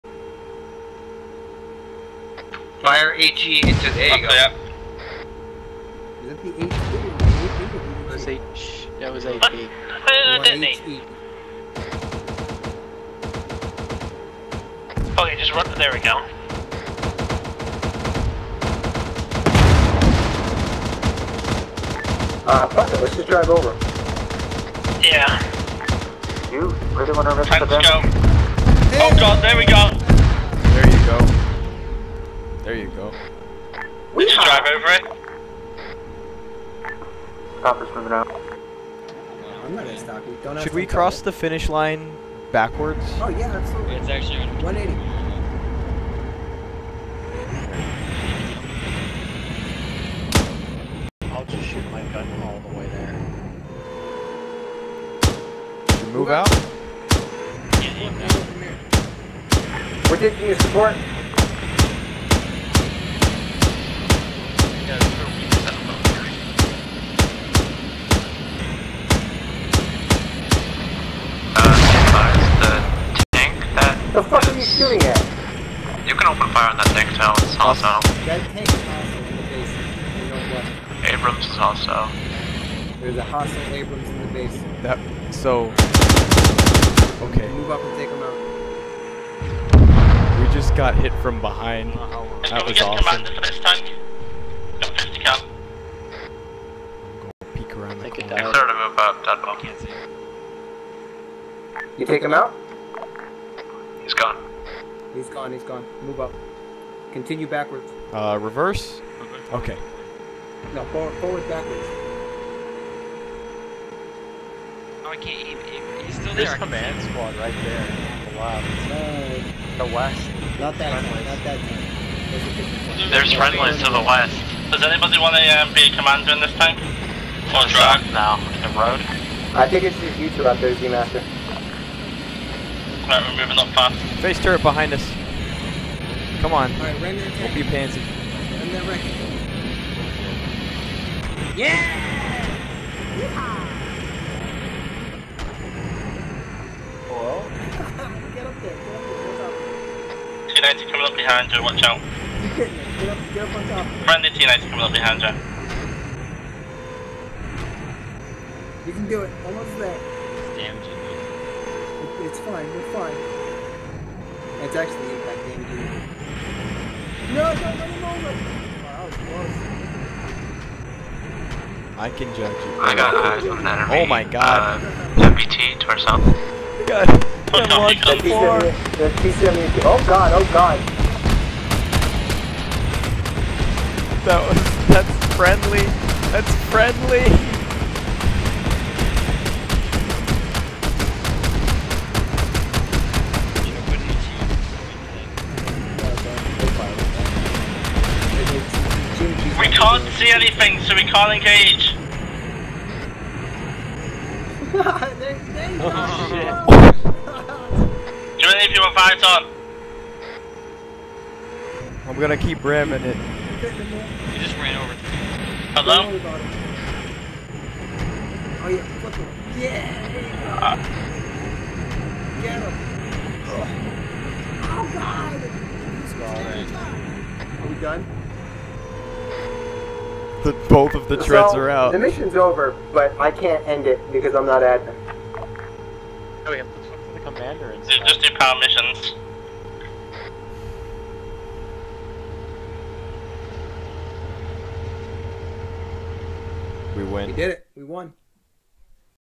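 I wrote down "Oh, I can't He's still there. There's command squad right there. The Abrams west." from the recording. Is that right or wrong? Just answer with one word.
wrong.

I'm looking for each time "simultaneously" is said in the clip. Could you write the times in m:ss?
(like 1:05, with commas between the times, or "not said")
not said.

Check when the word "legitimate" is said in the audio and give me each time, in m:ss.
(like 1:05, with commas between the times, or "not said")
not said.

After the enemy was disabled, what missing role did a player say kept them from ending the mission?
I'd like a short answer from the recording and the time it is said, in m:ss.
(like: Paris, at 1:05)
admin, at 3:54.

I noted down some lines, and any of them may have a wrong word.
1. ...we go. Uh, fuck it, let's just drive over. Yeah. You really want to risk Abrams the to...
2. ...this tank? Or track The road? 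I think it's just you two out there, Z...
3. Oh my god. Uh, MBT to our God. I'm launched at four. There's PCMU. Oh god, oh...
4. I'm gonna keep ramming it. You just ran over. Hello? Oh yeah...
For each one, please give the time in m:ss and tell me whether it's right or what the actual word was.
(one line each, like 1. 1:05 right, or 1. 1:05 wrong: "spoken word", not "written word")
1. 0:15 wrong: "Time", not "Abrams"
2. 2:06 right
3. 2:54 right
4. 3:32 right.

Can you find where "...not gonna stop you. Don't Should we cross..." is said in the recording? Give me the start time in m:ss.
0:39.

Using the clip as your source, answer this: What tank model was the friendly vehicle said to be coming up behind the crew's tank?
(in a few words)
T90.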